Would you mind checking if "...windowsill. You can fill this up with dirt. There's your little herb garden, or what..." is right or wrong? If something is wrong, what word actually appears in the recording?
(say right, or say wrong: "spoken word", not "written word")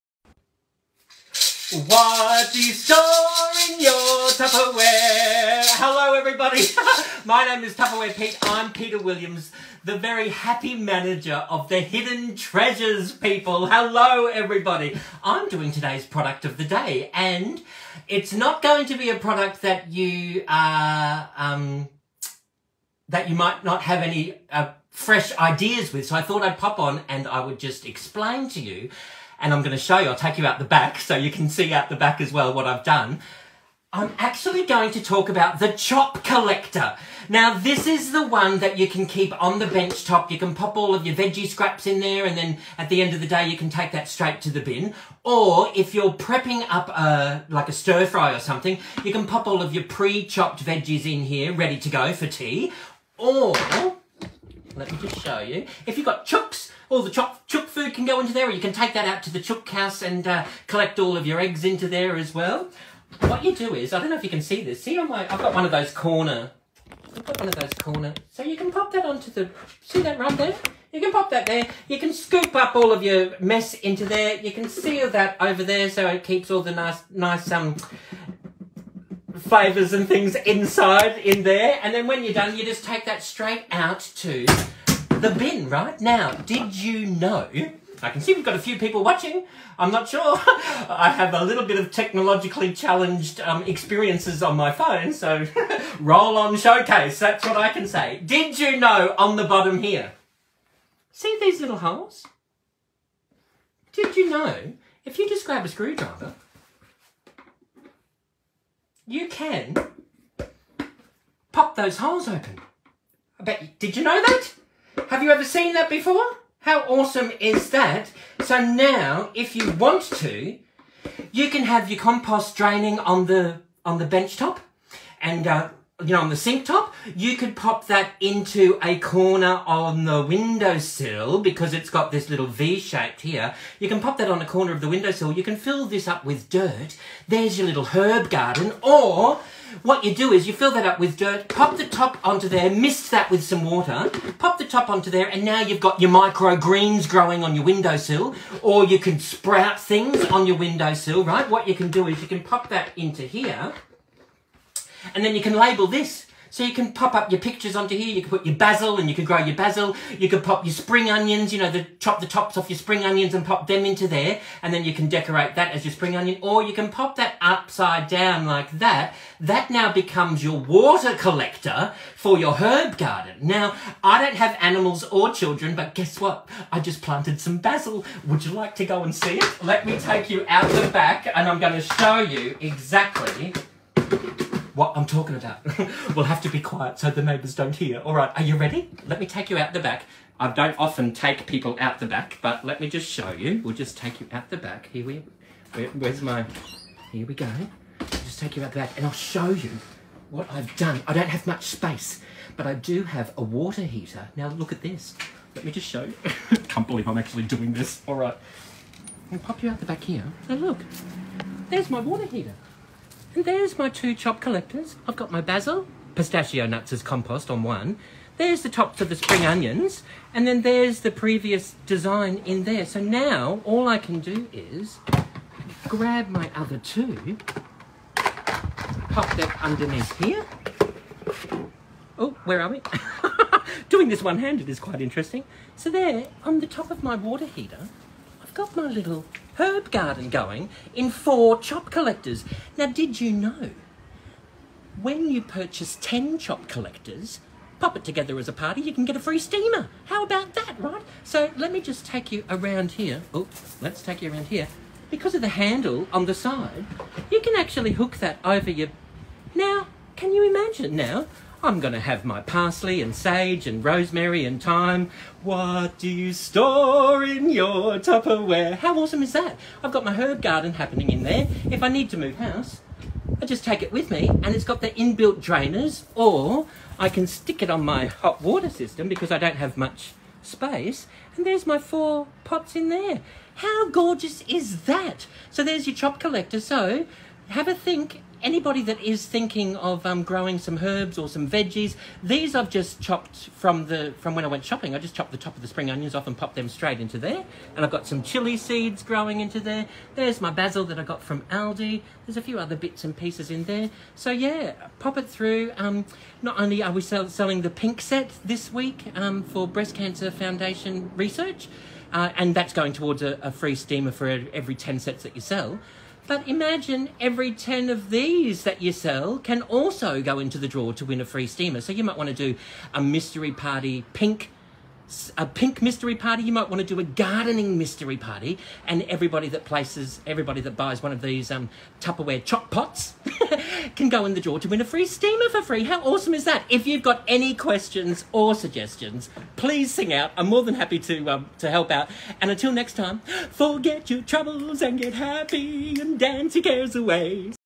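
right.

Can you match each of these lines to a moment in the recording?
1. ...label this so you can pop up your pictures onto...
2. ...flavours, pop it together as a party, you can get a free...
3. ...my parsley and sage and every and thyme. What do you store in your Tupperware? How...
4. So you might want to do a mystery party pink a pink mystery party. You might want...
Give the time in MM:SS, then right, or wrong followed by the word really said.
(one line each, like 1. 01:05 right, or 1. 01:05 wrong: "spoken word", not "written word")
1. 02:35 right
2. 04:06 wrong: "collectors", not "flavours"
3. 04:22 wrong: "rosemary", not "every"
4. 05:21 right.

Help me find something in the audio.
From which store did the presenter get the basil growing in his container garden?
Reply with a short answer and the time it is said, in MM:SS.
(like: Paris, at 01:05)
Aldi, at 05:01.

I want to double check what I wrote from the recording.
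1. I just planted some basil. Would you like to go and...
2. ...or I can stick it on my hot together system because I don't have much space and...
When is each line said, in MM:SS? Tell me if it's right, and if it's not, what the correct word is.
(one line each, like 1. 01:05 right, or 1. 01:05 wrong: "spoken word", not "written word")
1. 02:56 right
2. 04:36 wrong: "water", not "together".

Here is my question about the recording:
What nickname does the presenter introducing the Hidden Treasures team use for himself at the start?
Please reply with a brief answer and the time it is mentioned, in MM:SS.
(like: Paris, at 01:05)
Tupperware Pete, at 00:07.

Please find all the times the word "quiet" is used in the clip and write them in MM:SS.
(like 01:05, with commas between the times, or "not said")
03:06.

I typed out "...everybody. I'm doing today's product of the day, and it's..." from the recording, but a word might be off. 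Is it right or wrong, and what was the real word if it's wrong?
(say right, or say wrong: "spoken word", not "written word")
right.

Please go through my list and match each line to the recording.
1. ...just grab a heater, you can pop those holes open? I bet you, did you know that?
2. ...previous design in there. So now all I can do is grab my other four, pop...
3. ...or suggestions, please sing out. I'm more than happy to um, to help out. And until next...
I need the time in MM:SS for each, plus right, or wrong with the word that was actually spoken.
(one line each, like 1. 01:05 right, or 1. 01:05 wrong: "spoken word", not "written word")
1. 01:45 wrong: "screwdriver", not "heater"
2. 03:41 wrong: "two", not "four"
3. 05:38 right.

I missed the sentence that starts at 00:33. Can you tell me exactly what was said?
I'm actually going to talk about the chop collector.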